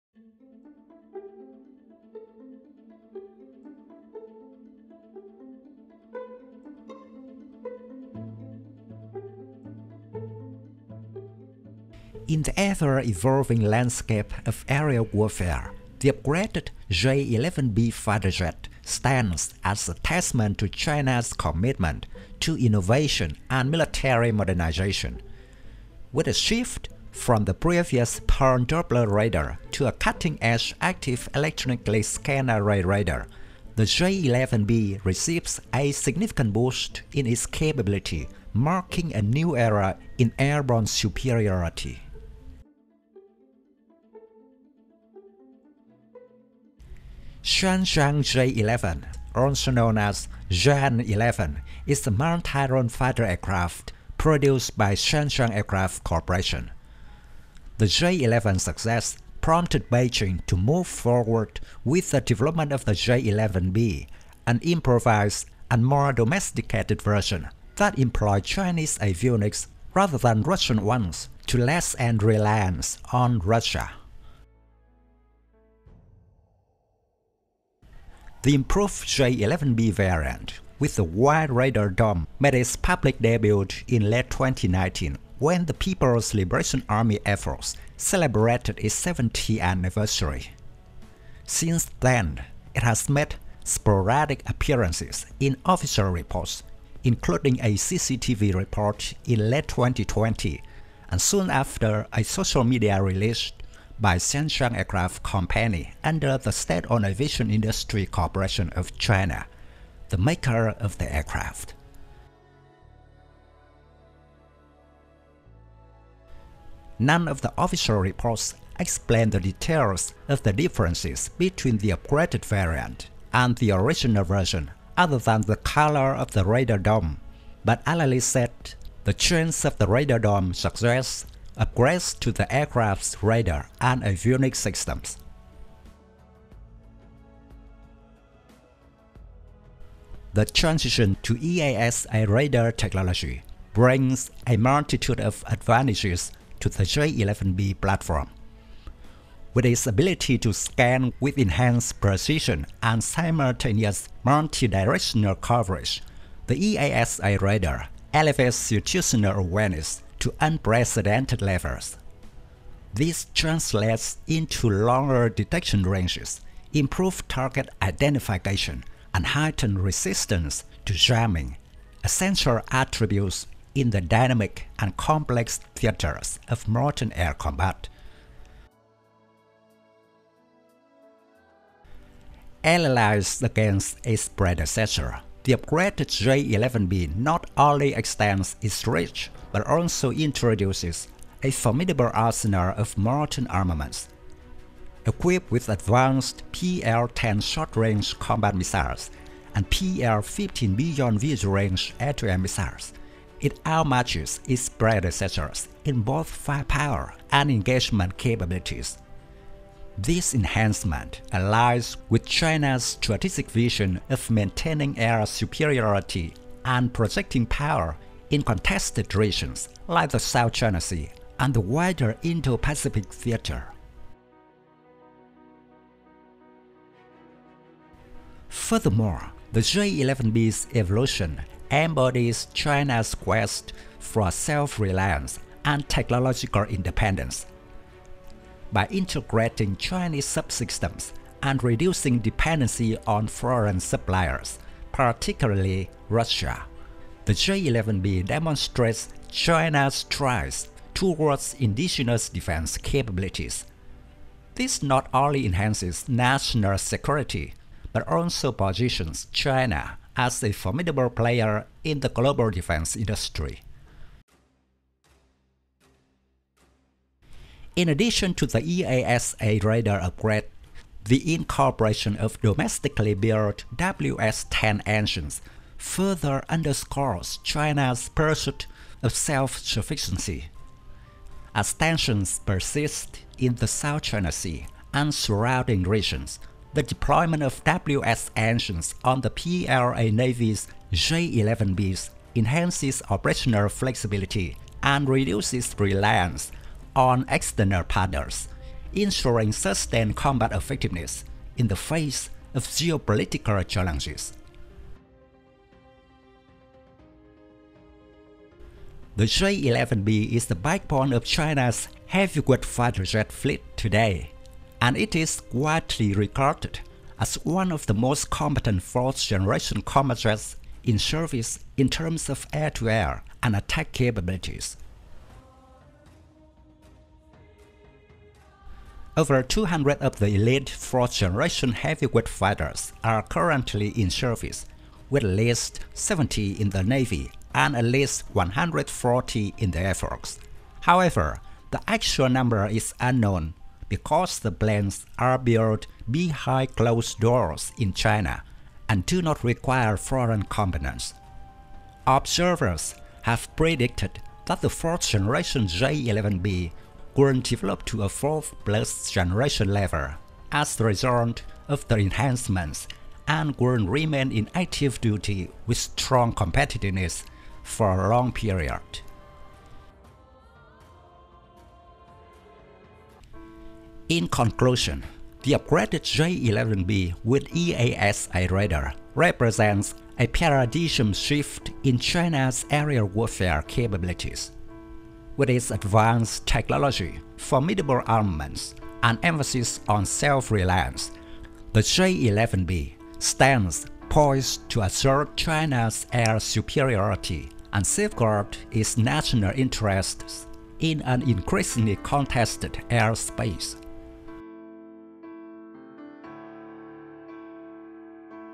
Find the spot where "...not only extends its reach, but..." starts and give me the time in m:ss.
3:07.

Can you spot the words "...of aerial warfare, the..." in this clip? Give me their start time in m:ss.
0:14.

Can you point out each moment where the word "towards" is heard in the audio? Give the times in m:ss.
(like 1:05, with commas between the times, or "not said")
4:10.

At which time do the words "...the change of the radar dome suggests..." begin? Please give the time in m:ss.
2:09.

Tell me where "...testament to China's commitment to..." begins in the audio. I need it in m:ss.
0:19.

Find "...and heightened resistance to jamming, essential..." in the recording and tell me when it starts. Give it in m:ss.
2:49.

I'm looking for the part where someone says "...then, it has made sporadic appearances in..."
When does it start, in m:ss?
1:31.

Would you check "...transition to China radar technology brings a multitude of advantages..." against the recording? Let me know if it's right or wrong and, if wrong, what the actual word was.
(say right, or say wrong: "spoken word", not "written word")
wrong: "AESA", not "China".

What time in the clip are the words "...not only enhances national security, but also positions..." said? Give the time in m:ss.
4:14.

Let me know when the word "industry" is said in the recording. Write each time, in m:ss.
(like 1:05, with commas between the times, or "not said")
1:47, 4:22.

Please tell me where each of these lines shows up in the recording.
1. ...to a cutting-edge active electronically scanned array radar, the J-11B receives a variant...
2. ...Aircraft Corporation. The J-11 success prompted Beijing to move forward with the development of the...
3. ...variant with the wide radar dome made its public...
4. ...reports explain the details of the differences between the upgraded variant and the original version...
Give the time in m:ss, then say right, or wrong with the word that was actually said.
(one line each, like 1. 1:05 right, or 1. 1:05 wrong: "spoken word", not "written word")
1. 0:29 wrong: "significant", not "variant"
2. 0:55 right
3. 1:19 right
4. 1:57 right.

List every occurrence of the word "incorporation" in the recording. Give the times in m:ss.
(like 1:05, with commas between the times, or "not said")
4:31.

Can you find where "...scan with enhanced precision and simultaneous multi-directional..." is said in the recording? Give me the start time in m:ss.
2:30.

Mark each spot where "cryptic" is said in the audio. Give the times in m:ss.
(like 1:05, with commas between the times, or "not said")
not said.